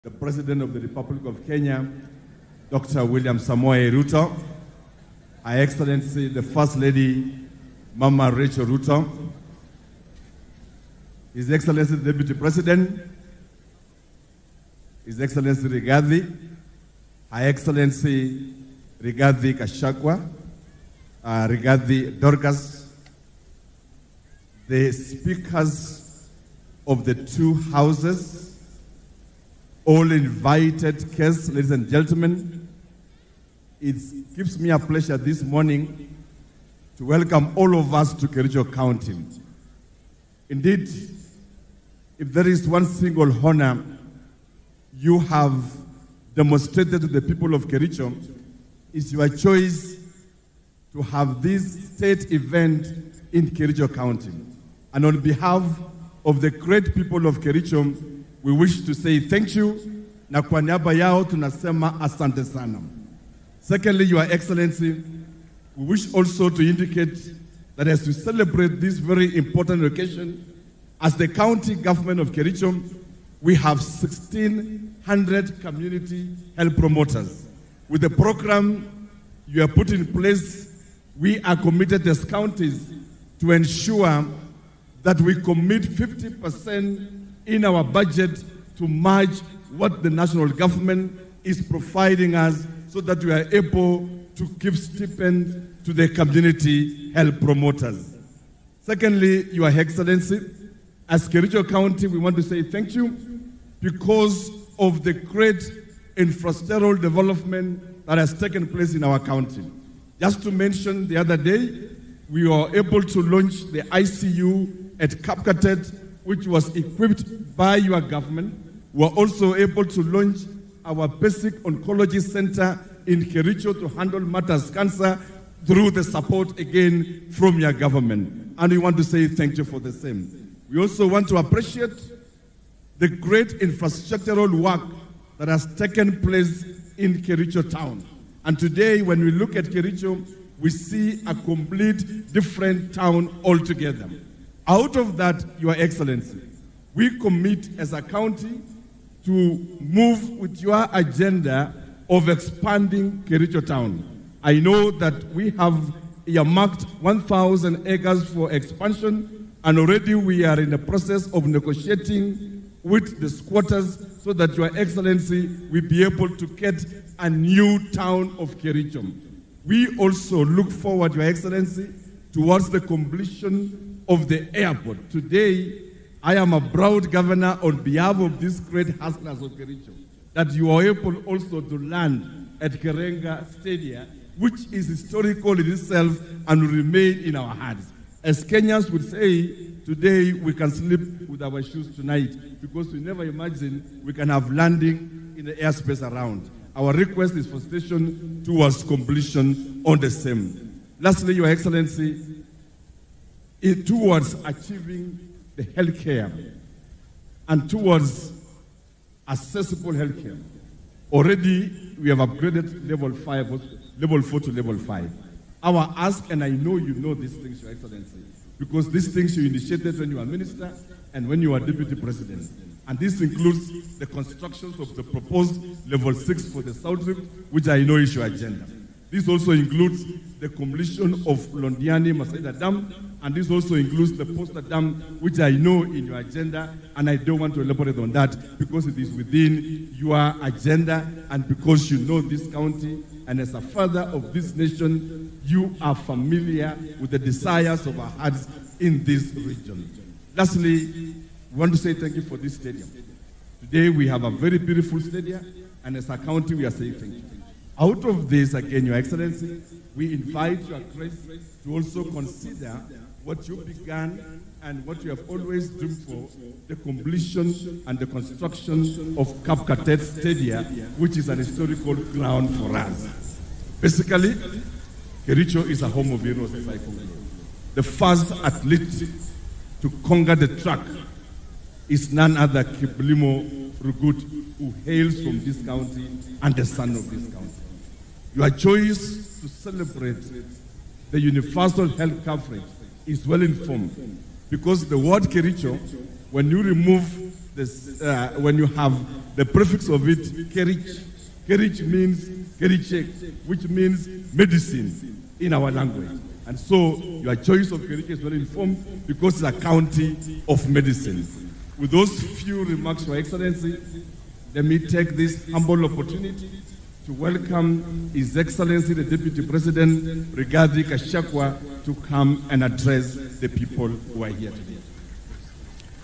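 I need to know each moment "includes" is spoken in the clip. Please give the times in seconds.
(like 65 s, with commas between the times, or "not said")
223 s, 229 s, 233 s.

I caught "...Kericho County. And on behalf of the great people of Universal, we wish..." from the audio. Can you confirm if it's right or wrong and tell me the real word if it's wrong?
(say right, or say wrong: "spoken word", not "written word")
wrong: "Kericho", not "Universal".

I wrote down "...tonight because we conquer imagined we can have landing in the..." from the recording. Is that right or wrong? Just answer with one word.
wrong.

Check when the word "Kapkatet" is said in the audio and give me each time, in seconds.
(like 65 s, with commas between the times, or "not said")
115 s, 269 s.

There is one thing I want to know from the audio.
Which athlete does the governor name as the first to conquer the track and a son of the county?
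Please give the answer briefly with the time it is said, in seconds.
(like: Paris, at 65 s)
Kiblimo Rugut, at 282 s.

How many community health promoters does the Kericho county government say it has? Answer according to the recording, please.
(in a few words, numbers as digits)
1,600.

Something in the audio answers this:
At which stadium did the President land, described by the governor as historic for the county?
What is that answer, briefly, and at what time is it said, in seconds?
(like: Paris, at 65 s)
Kerenga Stadium, at 182 s.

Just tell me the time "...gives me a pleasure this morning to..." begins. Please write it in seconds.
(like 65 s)
34 s.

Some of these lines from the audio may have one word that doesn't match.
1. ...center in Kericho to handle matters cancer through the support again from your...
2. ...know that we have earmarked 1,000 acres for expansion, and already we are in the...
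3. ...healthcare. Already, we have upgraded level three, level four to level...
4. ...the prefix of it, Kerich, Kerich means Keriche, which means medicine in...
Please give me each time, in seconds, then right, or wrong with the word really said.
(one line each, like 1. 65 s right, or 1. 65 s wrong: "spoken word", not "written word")
1. 122 s right
2. 154 s right
3. 209 s wrong: "five", not "three"
4. 299 s right.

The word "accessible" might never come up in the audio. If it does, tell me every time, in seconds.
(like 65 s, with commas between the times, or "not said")
209 s.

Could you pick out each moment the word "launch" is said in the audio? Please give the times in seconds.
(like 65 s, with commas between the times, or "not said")
113 s, 120 s.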